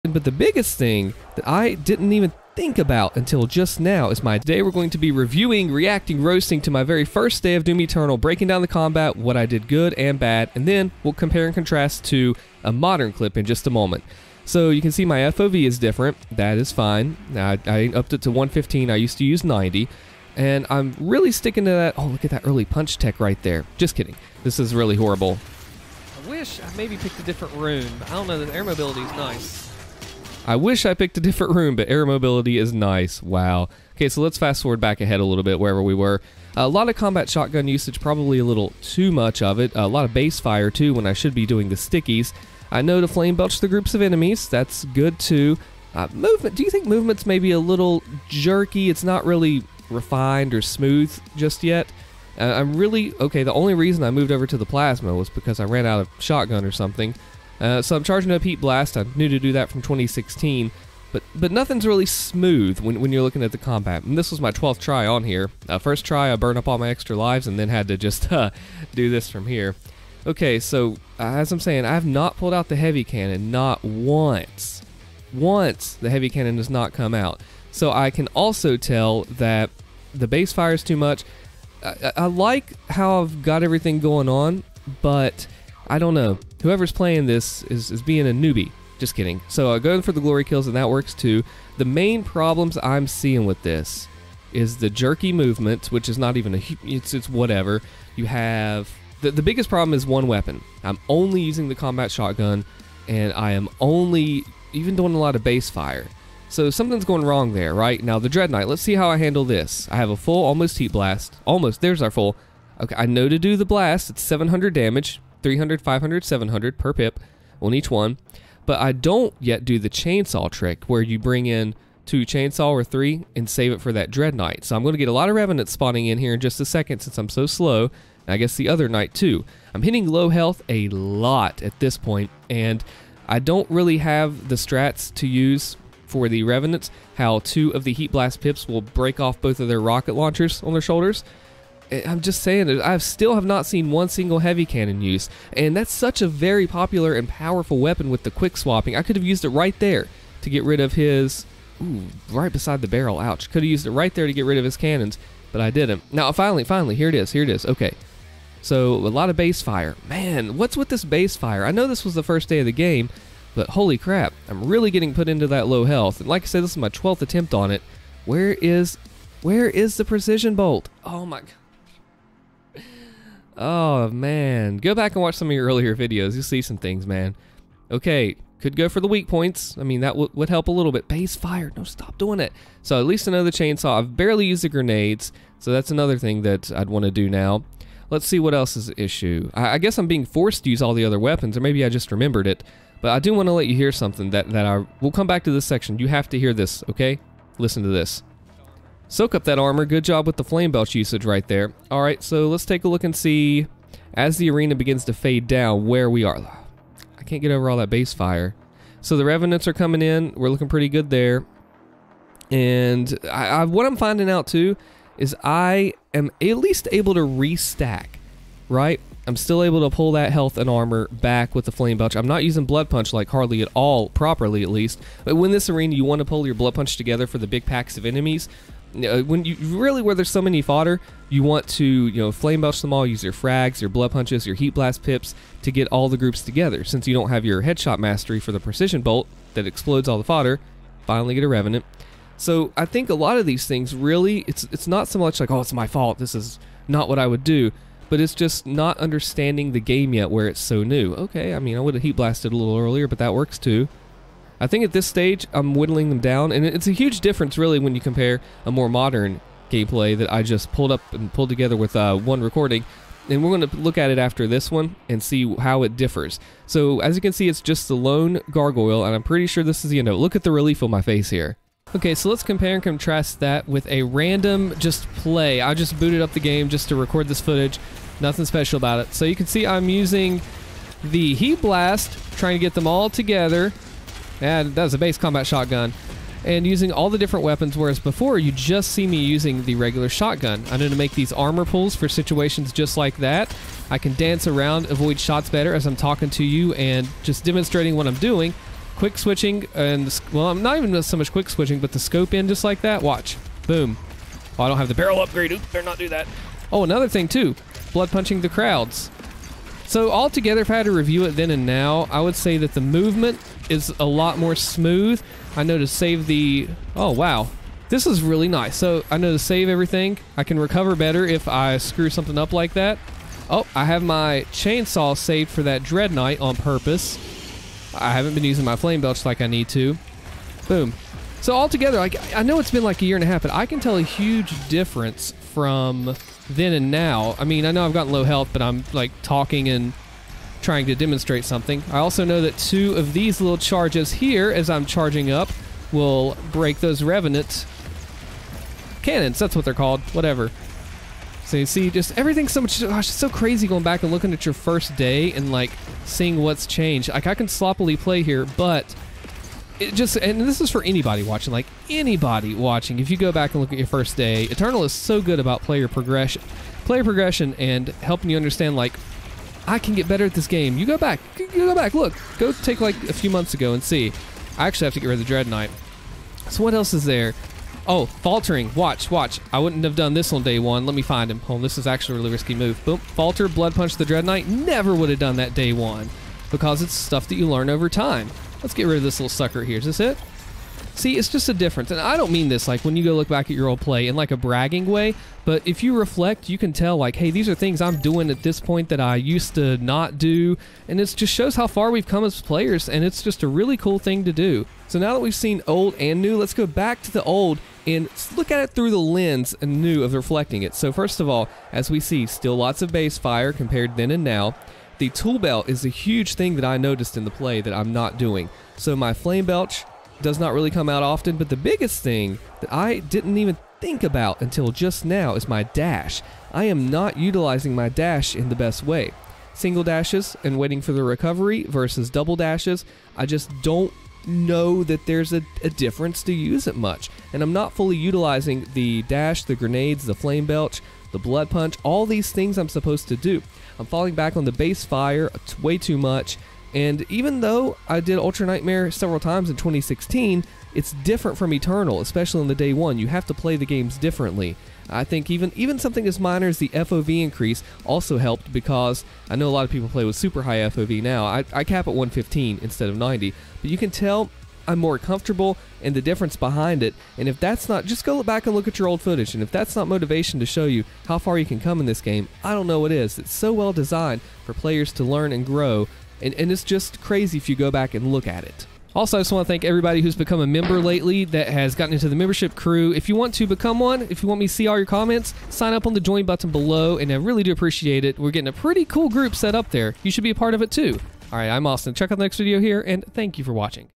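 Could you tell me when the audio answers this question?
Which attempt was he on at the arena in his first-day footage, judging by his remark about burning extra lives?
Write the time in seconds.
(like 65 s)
64 s.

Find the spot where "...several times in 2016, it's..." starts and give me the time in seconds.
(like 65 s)
448 s.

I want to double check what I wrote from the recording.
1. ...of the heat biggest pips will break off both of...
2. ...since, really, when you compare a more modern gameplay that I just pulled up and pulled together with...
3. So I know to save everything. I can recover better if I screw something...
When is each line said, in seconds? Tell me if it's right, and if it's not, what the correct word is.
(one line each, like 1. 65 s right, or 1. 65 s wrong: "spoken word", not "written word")
1. 137 s wrong: "blast", not "biggest"
2. 257 s wrong: "difference", not "since"
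3. 318 s right.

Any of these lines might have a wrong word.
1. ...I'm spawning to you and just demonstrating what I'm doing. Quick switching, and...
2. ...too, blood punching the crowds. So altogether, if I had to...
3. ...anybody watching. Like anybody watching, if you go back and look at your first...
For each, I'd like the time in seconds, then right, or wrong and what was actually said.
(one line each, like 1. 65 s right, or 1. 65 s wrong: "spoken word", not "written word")
1. 295 s wrong: "talking", not "spawning"
2. 307 s right
3. 360 s right.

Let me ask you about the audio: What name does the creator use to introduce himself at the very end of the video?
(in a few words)
Allstin.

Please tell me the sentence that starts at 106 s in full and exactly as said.
So something's going wrong there, right?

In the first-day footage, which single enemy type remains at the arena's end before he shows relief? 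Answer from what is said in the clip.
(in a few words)
gargoyle.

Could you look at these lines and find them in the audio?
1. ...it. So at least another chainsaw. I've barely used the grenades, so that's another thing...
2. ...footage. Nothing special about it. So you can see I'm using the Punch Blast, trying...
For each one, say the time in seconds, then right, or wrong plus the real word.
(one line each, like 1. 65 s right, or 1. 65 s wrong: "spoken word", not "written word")
1. 182 s right
2. 277 s wrong: "Heat", not "Punch".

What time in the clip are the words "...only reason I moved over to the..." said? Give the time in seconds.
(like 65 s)
53 s.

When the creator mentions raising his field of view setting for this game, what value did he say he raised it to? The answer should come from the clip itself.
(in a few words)
115.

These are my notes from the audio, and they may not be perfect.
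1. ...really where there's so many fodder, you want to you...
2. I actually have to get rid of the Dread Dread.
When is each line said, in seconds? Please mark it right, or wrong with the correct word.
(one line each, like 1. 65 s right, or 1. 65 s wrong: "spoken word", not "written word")
1. 229 s right
2. 374 s wrong: "Knight", not "Dread".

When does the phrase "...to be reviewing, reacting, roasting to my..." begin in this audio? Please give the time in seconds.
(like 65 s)
4 s.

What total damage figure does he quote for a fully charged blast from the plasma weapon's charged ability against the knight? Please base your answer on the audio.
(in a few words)
700.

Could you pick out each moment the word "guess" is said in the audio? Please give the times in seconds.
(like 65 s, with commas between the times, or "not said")
128 s, 189 s.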